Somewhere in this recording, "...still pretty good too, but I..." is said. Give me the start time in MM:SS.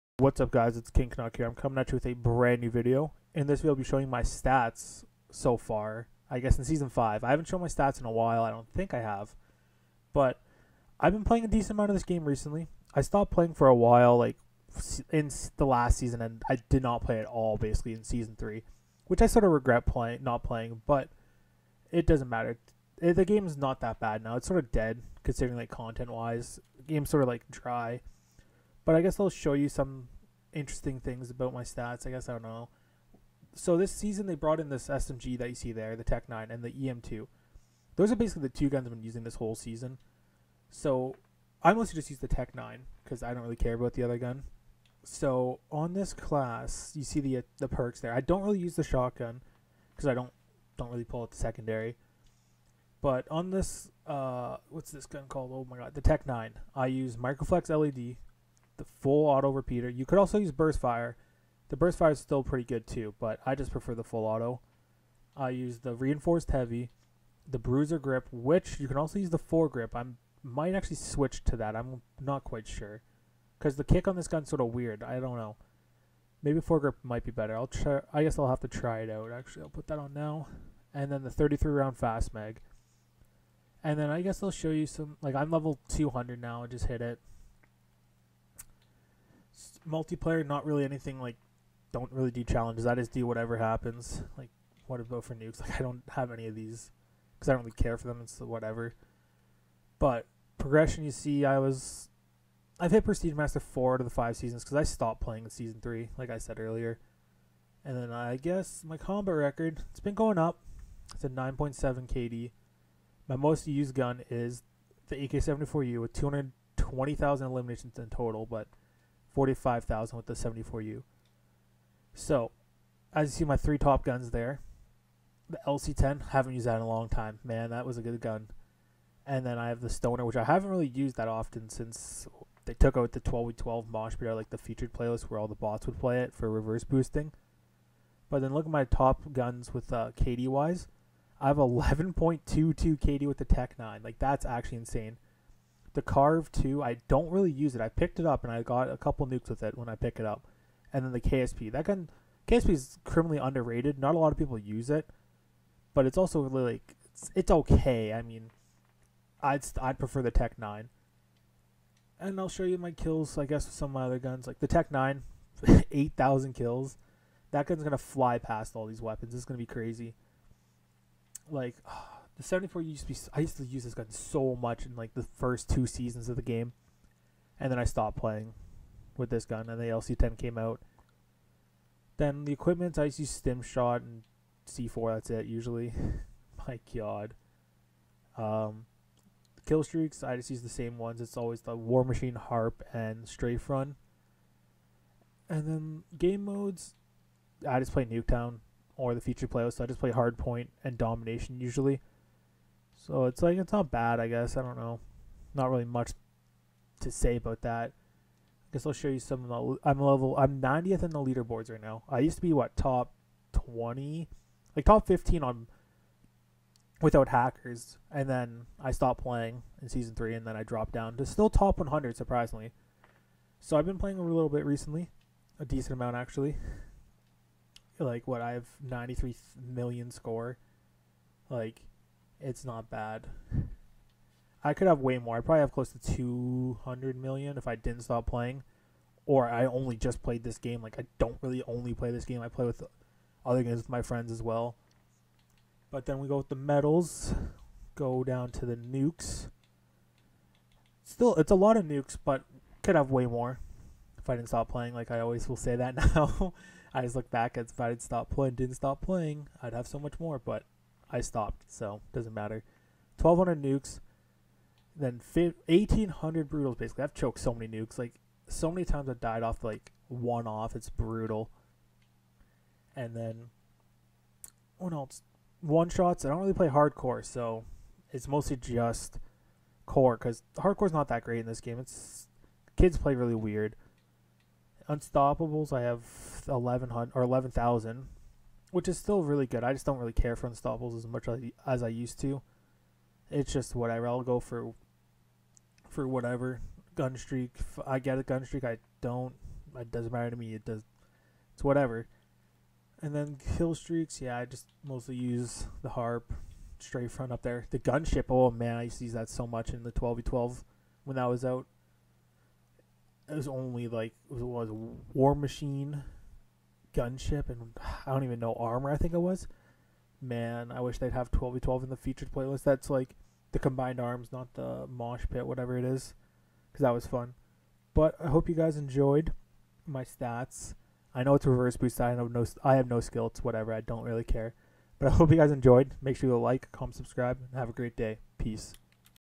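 01:02.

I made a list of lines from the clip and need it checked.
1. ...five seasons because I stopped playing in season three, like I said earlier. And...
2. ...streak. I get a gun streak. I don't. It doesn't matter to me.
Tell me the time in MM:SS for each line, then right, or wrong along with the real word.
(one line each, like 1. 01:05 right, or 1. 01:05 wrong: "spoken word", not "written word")
1. 01:44 right
2. 04:57 right.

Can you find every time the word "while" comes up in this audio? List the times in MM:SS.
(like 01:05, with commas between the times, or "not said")
00:08, 00:13.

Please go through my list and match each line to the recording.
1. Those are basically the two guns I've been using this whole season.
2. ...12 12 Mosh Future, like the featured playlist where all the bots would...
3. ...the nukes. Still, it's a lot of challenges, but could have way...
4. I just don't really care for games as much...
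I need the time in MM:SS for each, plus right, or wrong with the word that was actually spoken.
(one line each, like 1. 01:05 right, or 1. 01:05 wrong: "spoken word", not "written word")
1. 00:37 right
2. 02:13 wrong: "Pit", not "Future"
3. 04:08 wrong: "nukes", not "challenges"
4. 04:49 wrong: "unstoppables", not "games".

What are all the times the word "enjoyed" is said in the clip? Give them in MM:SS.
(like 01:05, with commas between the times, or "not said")
05:28, 05:35.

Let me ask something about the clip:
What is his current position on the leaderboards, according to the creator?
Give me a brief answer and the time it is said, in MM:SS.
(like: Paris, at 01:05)
90th, at 03:30.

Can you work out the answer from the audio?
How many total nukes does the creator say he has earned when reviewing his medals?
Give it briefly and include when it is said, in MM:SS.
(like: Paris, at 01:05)
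1,200, at 04:23.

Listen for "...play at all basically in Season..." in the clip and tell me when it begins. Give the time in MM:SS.
00:17.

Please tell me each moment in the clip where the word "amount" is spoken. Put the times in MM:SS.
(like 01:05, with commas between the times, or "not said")
00:11, 03:45.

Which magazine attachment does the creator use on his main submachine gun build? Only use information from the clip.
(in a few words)
33 round fast mag.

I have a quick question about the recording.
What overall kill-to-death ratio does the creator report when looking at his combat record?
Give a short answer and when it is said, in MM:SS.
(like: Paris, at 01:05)
9.7, at 01:51.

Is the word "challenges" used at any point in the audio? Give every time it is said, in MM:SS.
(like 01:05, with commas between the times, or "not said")
01:32.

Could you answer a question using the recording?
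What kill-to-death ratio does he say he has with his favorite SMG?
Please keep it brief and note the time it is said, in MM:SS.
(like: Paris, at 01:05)
11.22, at 02:21.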